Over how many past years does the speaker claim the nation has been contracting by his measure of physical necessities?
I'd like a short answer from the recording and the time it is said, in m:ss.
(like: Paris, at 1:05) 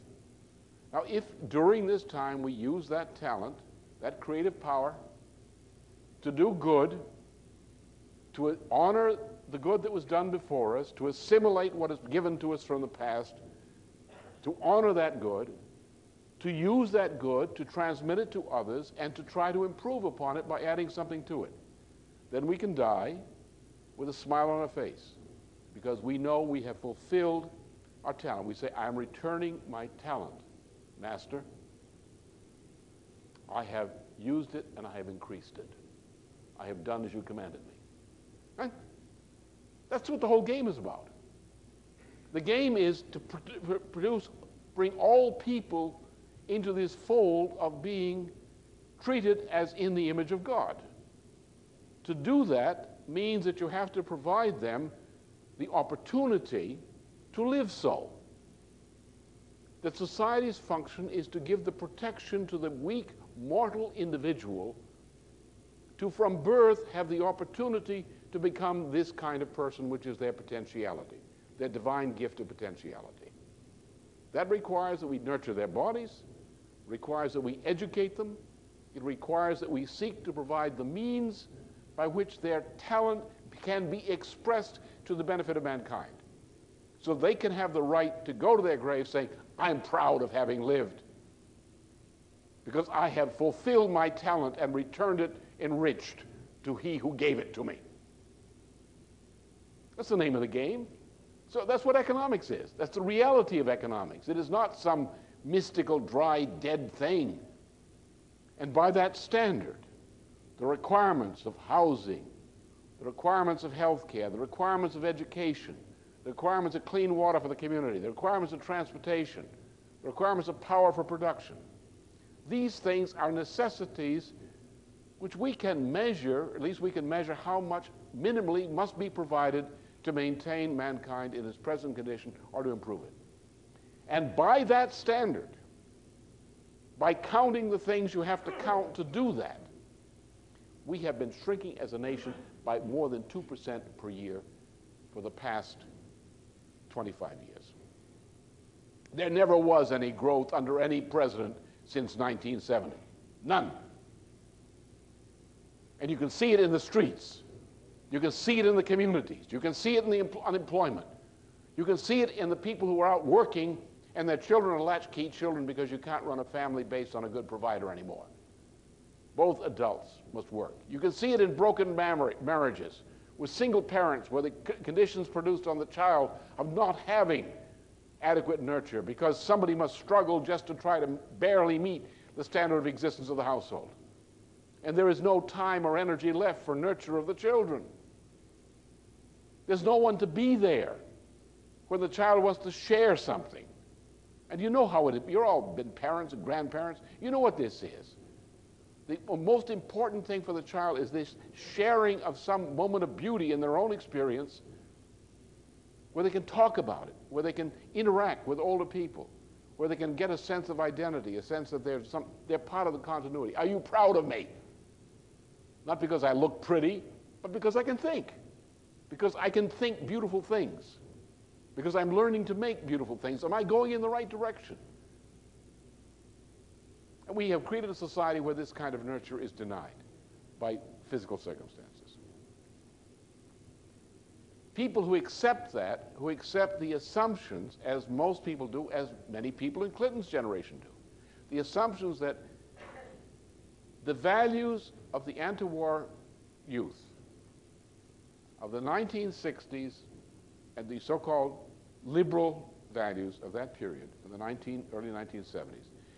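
25 years, at 2:26.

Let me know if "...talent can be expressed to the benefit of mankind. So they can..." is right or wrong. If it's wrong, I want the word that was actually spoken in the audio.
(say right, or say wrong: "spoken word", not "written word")
right.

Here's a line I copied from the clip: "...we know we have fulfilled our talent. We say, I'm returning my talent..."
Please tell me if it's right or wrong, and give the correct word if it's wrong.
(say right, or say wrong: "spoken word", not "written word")
right.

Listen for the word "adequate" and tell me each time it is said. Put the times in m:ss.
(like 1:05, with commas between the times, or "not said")
2:58.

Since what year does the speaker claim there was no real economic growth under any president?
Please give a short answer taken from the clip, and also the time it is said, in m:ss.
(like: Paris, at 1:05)
1970, at 2:32.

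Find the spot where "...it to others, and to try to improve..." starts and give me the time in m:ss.
0:18.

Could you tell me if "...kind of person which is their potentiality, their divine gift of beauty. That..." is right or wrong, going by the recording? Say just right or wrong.
wrong.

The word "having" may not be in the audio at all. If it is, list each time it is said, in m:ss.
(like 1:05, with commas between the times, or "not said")
1:30, 2:57.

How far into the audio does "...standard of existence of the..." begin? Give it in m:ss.
3:02.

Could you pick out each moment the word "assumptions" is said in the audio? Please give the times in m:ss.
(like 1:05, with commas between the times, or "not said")
3:56, 4:01.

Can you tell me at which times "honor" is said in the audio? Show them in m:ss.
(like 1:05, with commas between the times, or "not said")
0:08, 0:14.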